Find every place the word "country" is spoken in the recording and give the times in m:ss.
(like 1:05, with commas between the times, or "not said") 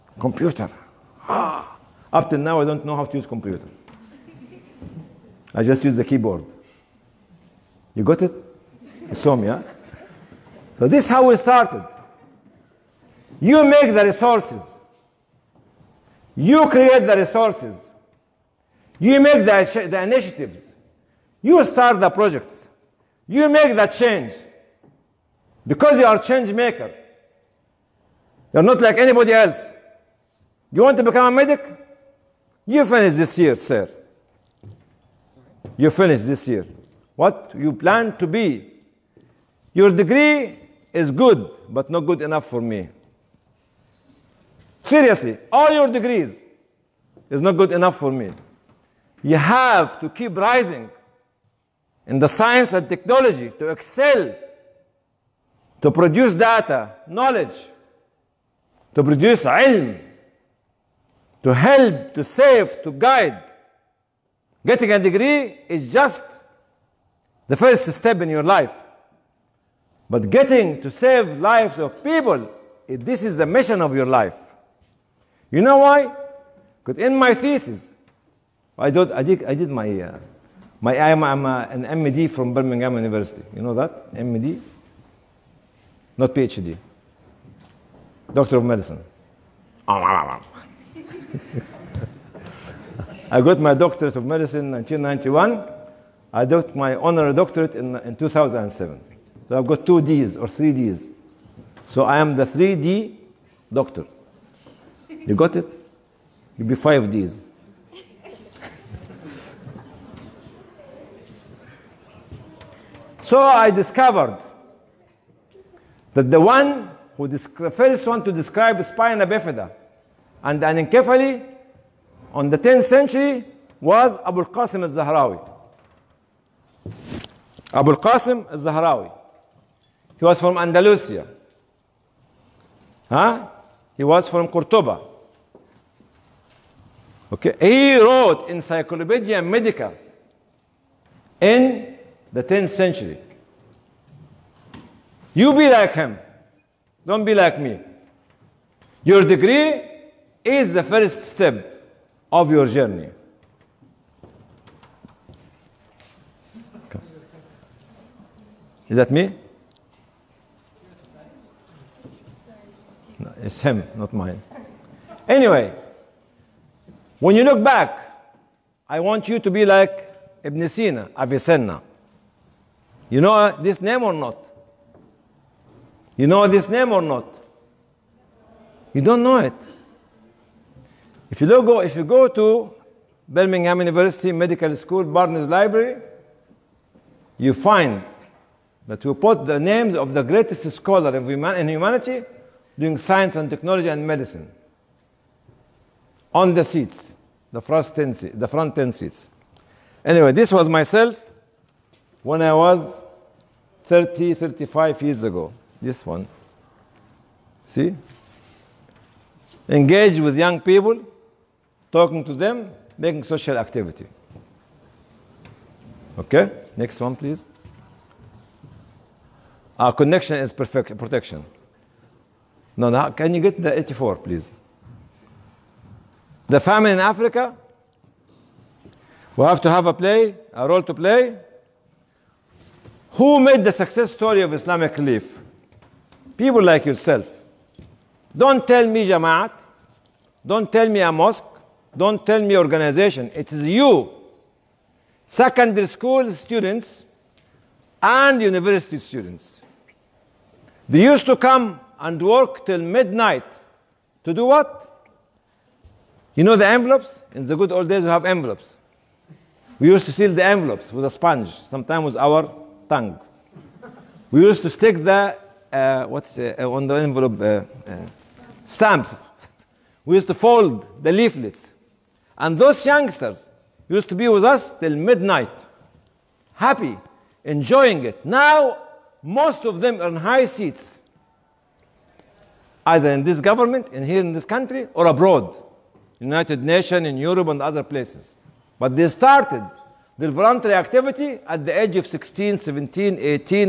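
4:44.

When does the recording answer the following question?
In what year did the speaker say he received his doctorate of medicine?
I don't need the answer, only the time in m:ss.
1:34.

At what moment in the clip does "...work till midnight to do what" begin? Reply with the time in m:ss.
4:12.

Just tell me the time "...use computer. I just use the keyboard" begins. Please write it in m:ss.
0:03.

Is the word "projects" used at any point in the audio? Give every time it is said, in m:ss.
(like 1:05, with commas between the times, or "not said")
0:22.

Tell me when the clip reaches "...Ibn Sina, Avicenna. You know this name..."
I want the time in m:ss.
2:50.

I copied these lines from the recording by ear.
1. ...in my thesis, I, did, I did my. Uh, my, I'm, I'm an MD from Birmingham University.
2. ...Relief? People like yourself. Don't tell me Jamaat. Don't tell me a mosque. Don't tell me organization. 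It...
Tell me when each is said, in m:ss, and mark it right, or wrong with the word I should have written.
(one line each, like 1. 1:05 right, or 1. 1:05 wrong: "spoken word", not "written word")
1. 1:16 right
2. 3:54 right.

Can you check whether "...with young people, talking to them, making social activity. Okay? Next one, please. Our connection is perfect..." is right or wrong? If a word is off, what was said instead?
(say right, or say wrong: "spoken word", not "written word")
right.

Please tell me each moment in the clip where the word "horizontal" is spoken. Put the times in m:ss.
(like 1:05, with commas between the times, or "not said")
not said.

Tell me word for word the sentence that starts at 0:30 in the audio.
You want to become a medic?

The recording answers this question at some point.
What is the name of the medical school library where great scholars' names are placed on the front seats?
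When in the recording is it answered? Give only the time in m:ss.
3:05.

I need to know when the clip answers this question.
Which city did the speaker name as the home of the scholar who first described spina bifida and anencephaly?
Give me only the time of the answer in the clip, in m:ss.
2:14.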